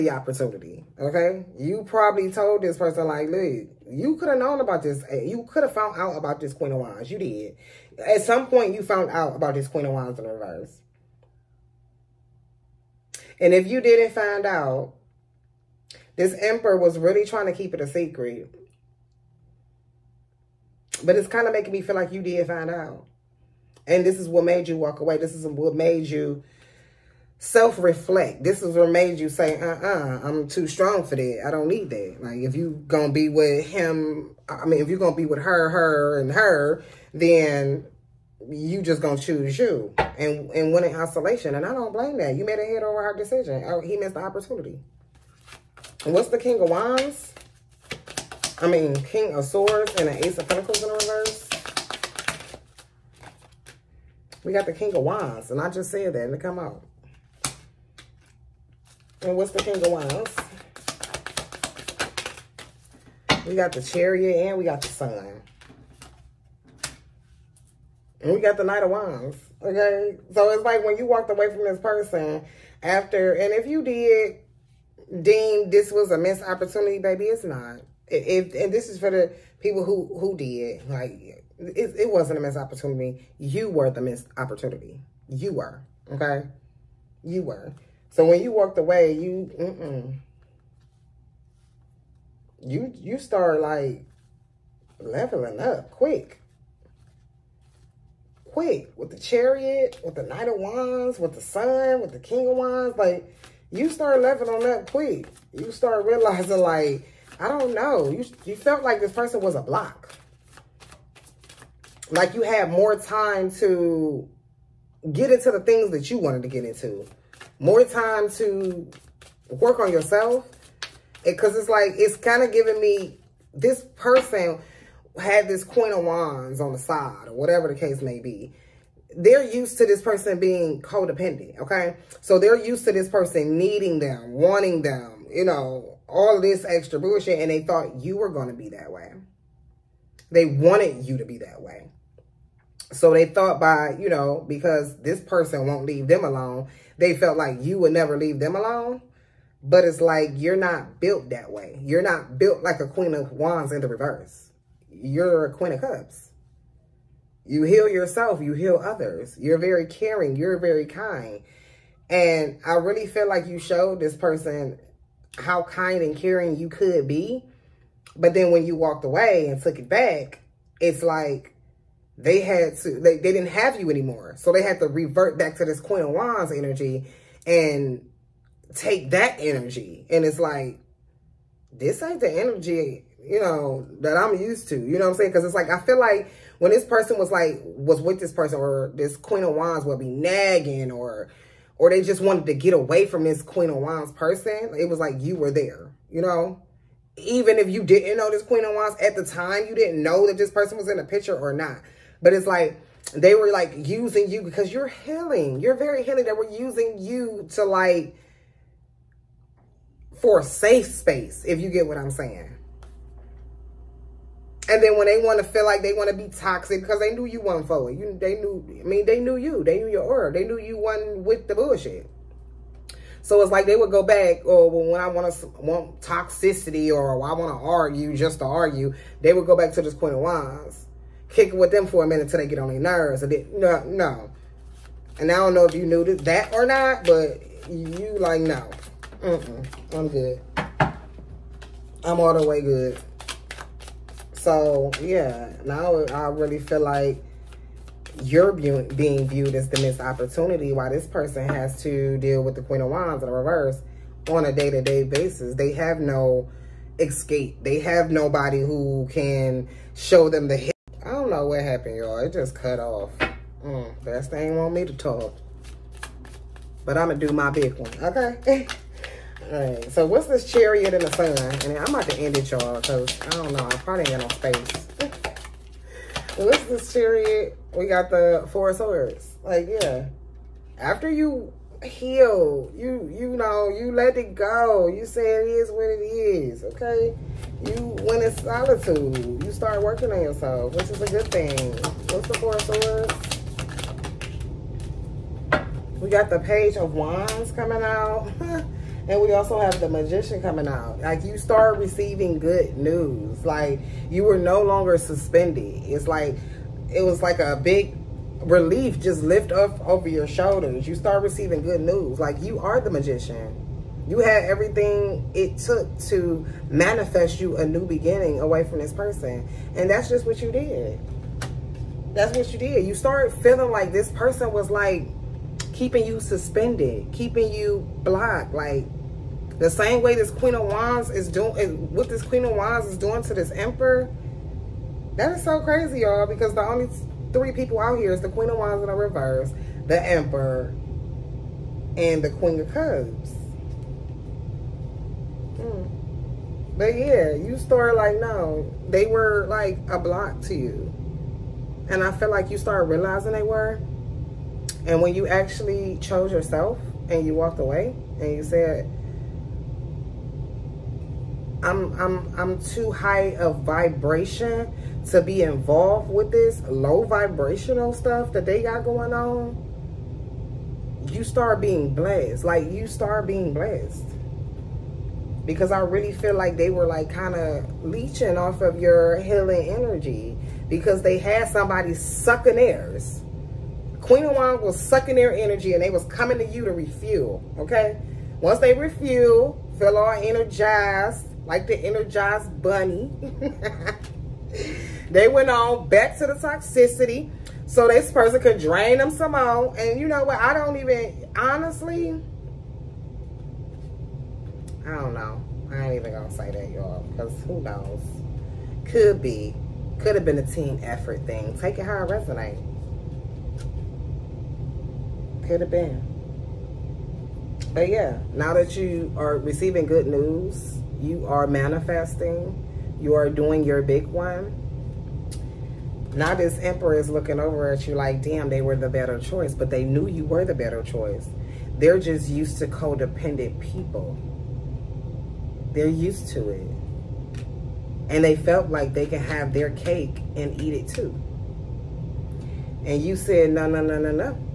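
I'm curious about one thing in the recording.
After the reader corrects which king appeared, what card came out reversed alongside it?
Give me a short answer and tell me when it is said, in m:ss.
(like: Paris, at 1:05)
Ace of Pentacles, at 0:50.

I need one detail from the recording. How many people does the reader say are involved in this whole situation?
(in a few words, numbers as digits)
3.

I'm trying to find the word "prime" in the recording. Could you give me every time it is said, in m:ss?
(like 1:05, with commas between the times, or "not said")
not said.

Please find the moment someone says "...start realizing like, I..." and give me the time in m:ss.
1:45.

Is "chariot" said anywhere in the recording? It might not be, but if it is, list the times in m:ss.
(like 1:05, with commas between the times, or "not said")
1:03, 1:39, 4:30, 4:36.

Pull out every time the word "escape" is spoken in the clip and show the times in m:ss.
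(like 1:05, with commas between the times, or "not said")
4:16.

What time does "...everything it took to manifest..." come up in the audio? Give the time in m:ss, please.
5:14.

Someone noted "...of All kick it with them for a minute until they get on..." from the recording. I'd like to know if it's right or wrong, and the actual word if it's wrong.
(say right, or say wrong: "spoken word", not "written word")
wrong: "Wands", not "All".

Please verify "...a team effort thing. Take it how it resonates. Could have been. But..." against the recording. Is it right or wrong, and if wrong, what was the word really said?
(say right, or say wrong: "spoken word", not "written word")
right.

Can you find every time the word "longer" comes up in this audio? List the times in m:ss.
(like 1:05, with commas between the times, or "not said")
5:04.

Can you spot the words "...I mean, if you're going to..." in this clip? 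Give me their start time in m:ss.
0:34.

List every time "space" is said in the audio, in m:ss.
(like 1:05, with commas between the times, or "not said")
3:30, 4:34.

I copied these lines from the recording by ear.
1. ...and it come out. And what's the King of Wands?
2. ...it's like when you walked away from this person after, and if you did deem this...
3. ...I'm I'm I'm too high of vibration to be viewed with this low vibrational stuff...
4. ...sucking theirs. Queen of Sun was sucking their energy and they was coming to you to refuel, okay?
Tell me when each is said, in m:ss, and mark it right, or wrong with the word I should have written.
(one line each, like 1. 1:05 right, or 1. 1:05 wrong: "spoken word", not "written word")
1. 0:56 right
2. 1:10 right
3. 6:01 wrong: "involved", not "viewed"
4. 6:21 wrong: "Wands", not "Sun".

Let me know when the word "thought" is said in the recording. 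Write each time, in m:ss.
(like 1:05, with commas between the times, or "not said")
2:17, 2:23.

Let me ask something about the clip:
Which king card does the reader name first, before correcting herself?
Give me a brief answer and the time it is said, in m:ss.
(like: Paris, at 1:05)
King of Swords, at 0:48.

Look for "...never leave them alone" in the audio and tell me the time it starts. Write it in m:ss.
2:27.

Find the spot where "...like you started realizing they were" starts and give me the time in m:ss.
5:52.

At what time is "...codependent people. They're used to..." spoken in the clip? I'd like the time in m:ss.
7:12.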